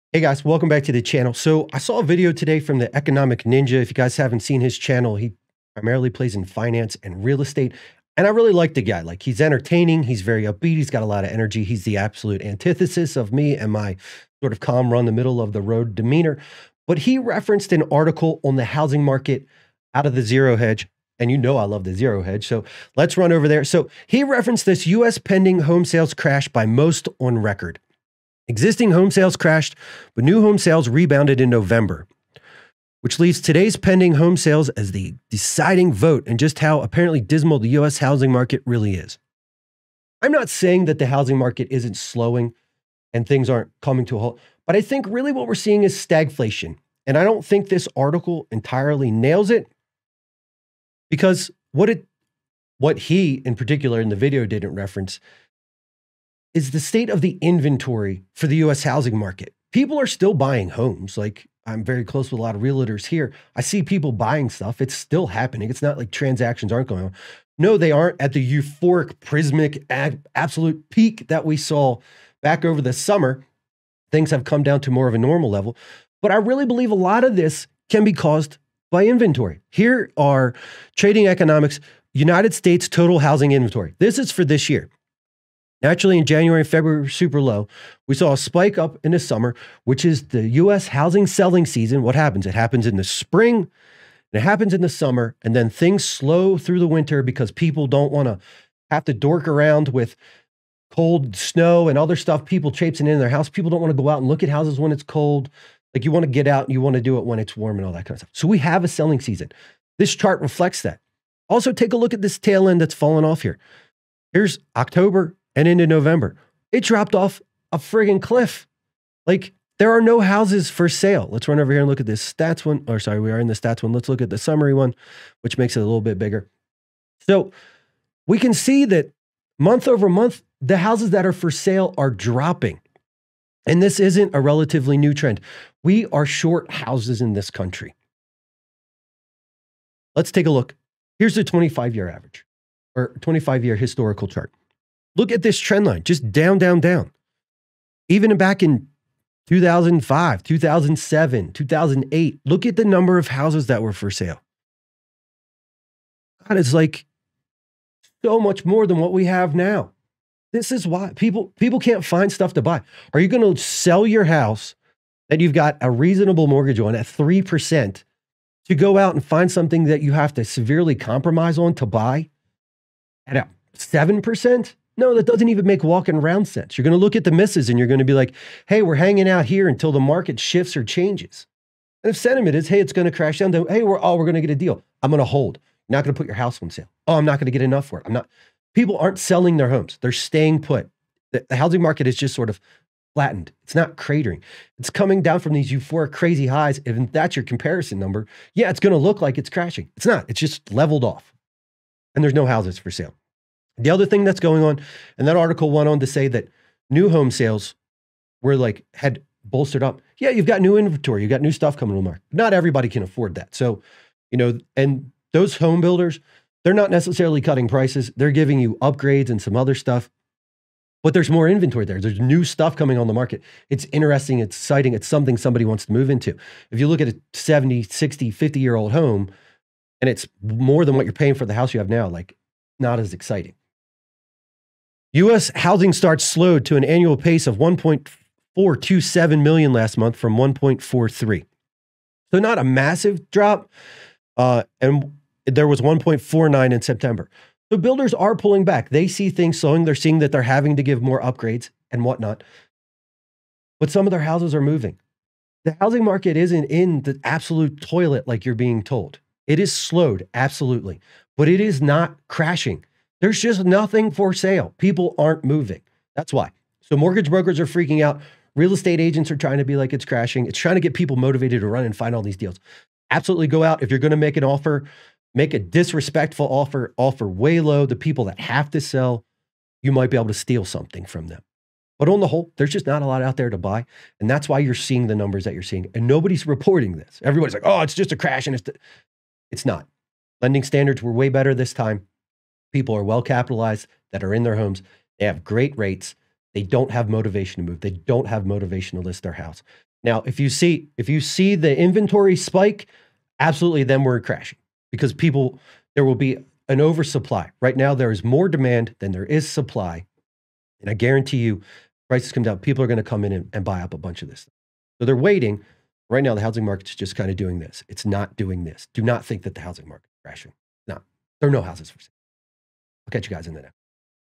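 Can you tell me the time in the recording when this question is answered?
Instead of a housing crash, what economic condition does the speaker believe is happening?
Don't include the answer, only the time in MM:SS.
00:45.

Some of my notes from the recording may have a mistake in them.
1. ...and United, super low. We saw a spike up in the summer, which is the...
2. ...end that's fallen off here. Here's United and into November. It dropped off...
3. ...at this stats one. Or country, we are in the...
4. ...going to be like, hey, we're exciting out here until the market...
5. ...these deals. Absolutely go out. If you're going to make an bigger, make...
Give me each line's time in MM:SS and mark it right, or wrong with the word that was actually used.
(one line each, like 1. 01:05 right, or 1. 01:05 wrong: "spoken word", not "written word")
1. 01:26 wrong: "February", not "United"
2. 01:52 wrong: "October", not "United"
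3. 02:01 wrong: "sorry", not "country"
4. 02:57 wrong: "hanging", not "exciting"
5. 04:32 wrong: "offer", not "bigger".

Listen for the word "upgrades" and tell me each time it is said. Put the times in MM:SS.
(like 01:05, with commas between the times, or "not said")
03:38, 04:11.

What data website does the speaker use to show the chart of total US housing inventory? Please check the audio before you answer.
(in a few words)
Trading Economics.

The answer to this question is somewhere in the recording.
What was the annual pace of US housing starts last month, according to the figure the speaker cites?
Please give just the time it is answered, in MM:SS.
03:57.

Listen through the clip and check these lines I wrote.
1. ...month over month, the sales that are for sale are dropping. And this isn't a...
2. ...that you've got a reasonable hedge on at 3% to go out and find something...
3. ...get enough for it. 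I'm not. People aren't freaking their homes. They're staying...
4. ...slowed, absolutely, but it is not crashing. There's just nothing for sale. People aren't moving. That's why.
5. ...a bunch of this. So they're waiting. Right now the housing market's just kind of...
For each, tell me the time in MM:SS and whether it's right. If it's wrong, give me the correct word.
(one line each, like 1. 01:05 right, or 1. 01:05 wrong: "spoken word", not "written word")
1. 02:09 wrong: "houses", not "sales"
2. 02:45 wrong: "mortgage", not "hedge"
3. 03:07 wrong: "selling", not "freaking"
4. 04:19 right
5. 05:13 right.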